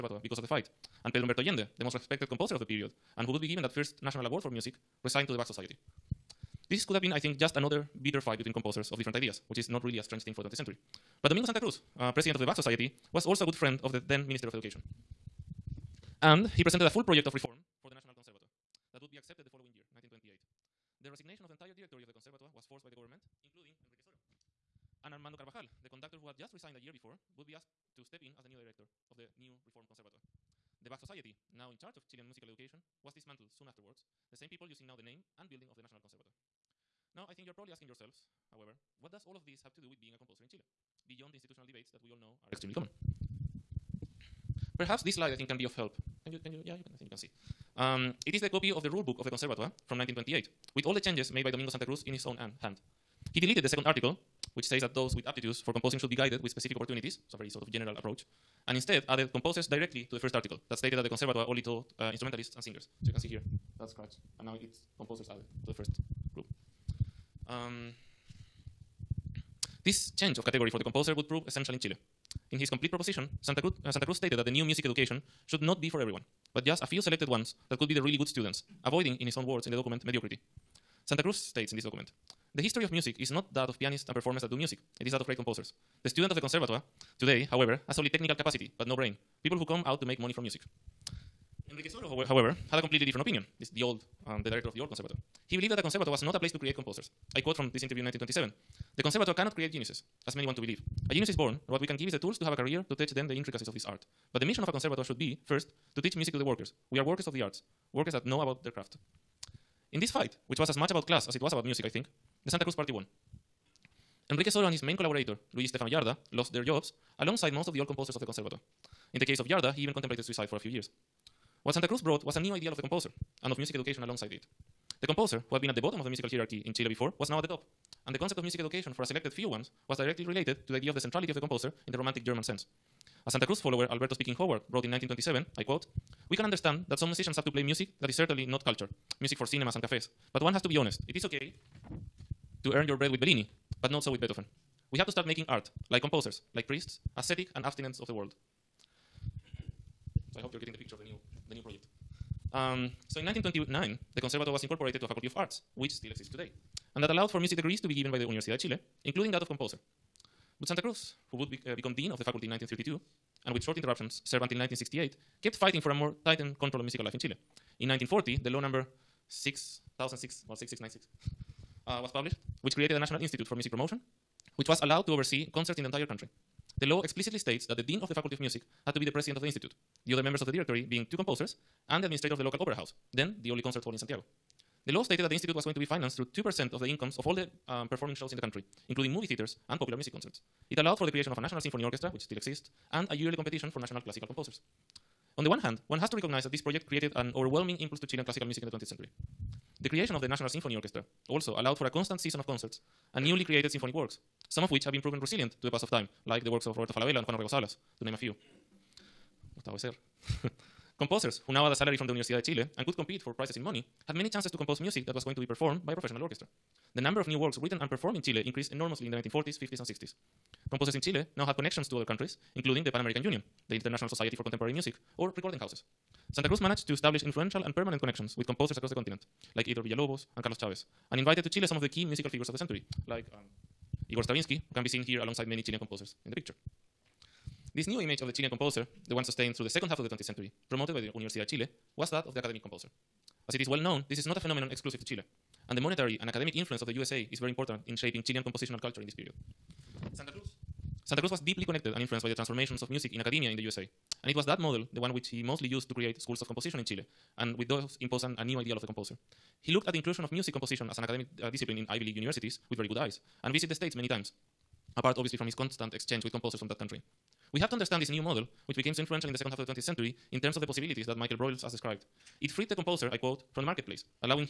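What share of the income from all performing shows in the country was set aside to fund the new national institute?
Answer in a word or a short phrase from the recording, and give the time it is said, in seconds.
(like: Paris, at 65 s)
2%, at 186 s.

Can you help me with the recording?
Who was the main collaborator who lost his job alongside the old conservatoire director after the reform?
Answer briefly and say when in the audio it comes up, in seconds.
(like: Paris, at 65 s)
Luigi Stefano Giarda, at 115 s.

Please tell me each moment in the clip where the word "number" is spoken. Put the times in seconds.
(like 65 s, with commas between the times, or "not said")
168 s, 217 s.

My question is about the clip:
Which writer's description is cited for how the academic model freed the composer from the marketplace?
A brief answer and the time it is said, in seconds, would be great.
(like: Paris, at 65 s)
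Michael Broyles, at 271 s.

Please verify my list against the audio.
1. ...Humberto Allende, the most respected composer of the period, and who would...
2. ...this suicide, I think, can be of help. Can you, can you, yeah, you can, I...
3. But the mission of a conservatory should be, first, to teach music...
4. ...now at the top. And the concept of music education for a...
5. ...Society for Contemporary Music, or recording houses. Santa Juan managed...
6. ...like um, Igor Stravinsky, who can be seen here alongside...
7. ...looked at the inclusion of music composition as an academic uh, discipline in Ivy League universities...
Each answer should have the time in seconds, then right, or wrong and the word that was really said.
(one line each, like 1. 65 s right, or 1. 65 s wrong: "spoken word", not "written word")
1. 1 s right
2. 45 s wrong: "slide", not "suicide"
3. 104 s right
4. 127 s right
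5. 224 s wrong: "Cruz", not "Juan"
6. 233 s right
7. 259 s right.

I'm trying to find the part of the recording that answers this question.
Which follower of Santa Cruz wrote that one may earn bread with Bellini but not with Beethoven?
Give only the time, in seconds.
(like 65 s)
133 s.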